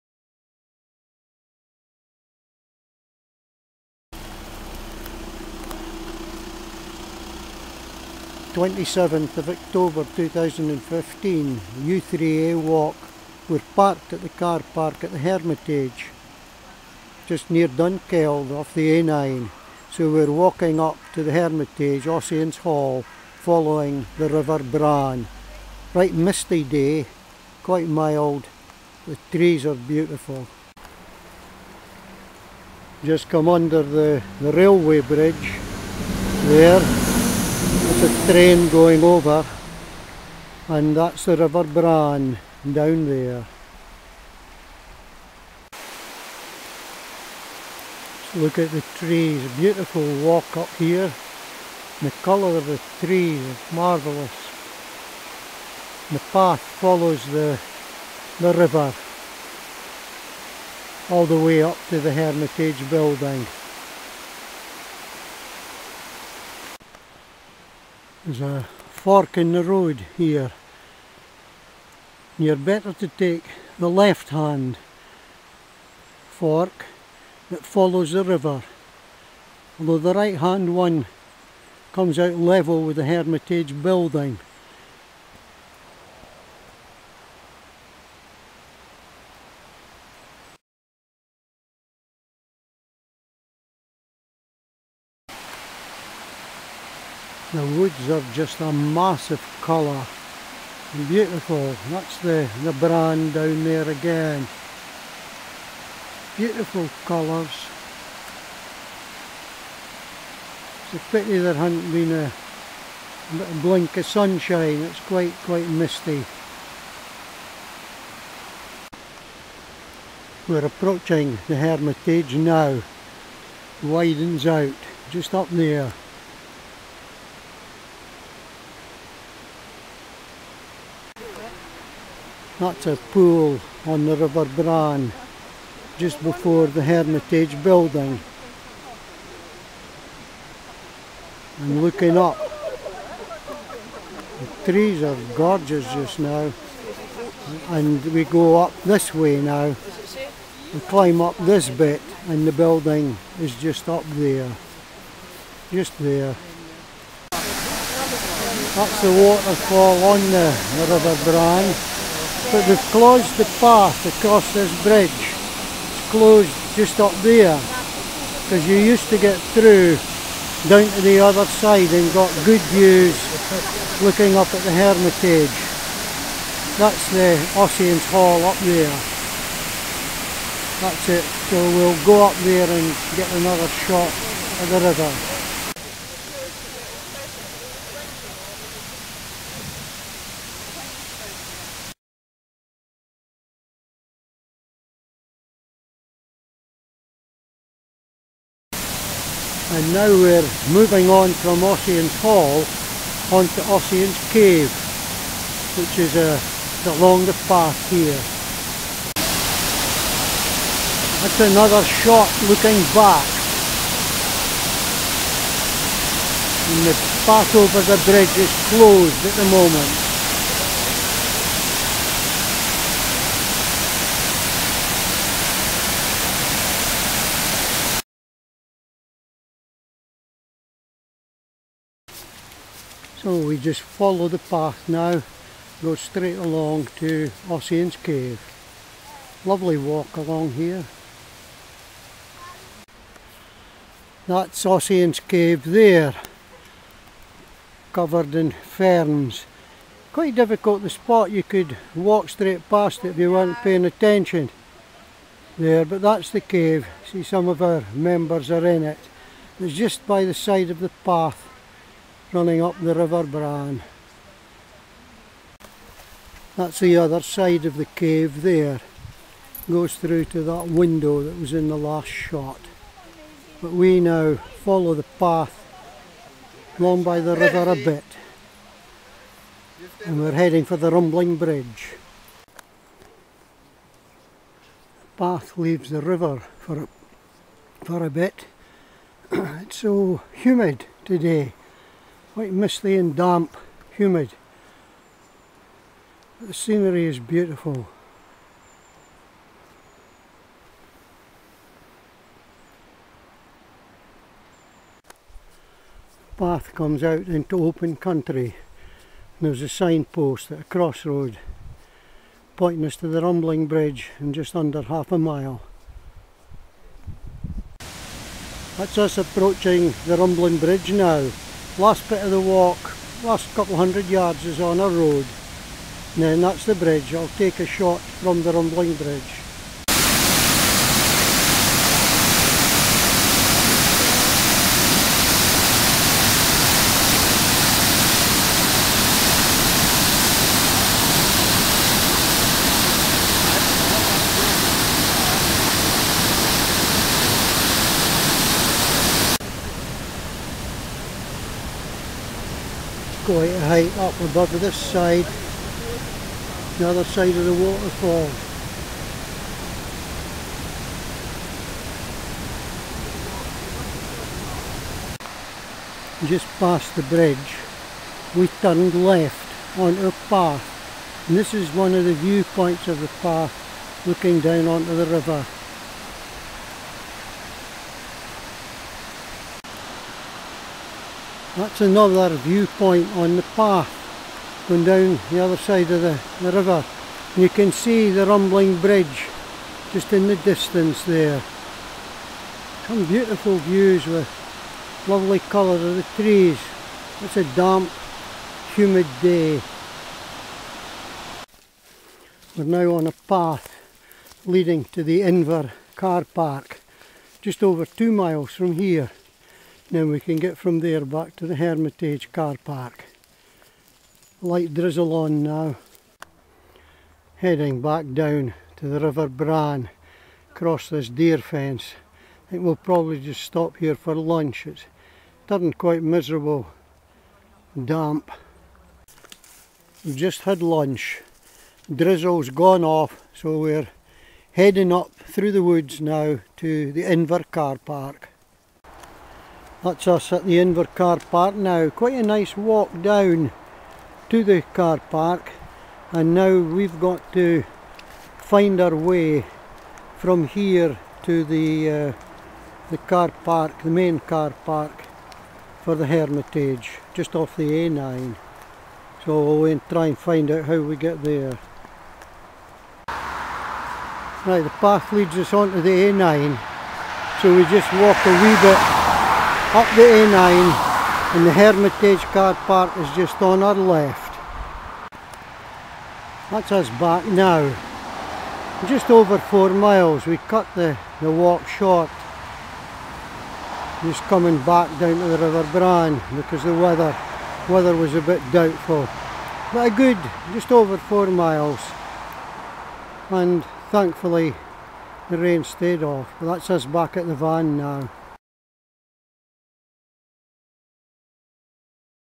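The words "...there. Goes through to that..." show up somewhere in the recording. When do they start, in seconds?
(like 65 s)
268 s.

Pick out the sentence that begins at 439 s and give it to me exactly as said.
That's us at the Invercar Park now.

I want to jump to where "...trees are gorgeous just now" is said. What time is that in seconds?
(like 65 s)
144 s.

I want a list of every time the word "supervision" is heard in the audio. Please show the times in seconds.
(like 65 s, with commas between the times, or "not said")
not said.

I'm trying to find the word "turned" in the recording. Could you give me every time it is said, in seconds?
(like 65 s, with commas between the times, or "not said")
368 s, 425 s.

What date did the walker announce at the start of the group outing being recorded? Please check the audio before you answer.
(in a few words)
27 October 2015.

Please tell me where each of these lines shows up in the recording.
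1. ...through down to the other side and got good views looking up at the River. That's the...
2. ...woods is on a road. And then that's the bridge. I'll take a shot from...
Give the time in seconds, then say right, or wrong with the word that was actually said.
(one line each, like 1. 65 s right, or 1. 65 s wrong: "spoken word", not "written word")
1. 169 s wrong: "Hermitage", not "River"
2. 324 s wrong: "yards", not "woods".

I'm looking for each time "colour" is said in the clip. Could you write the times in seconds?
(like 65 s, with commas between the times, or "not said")
52 s, 99 s, 107 s, 395 s.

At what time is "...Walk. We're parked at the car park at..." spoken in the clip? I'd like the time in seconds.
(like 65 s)
12 s.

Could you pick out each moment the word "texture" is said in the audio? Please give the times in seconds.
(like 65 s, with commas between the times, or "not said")
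not said.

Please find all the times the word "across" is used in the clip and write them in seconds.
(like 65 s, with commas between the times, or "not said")
164 s, 420 s.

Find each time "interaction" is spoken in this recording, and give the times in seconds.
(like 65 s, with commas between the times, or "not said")
not said.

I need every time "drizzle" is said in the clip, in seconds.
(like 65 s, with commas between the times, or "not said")
414 s, 431 s.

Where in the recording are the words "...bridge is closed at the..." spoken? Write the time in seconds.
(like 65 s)
218 s.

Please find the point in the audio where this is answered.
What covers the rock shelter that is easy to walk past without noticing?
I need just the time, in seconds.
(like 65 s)
248 s.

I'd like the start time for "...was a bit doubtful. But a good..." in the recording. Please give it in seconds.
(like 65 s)
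487 s.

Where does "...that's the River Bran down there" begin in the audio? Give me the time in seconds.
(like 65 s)
40 s.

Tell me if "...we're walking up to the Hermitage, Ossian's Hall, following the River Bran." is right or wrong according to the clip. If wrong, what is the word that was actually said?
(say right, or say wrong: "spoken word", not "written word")
right.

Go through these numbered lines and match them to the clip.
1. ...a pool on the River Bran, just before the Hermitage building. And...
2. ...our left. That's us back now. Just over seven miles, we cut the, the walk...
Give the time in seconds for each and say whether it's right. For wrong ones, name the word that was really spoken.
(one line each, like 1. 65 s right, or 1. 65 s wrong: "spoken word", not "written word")
1. 132 s right
2. 473 s wrong: "four", not "seven".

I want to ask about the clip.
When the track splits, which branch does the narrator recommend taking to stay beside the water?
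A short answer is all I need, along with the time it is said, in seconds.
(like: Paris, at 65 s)
The left hand fork, at 73 s.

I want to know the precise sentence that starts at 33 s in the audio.
Just come under the, the railway bridge there.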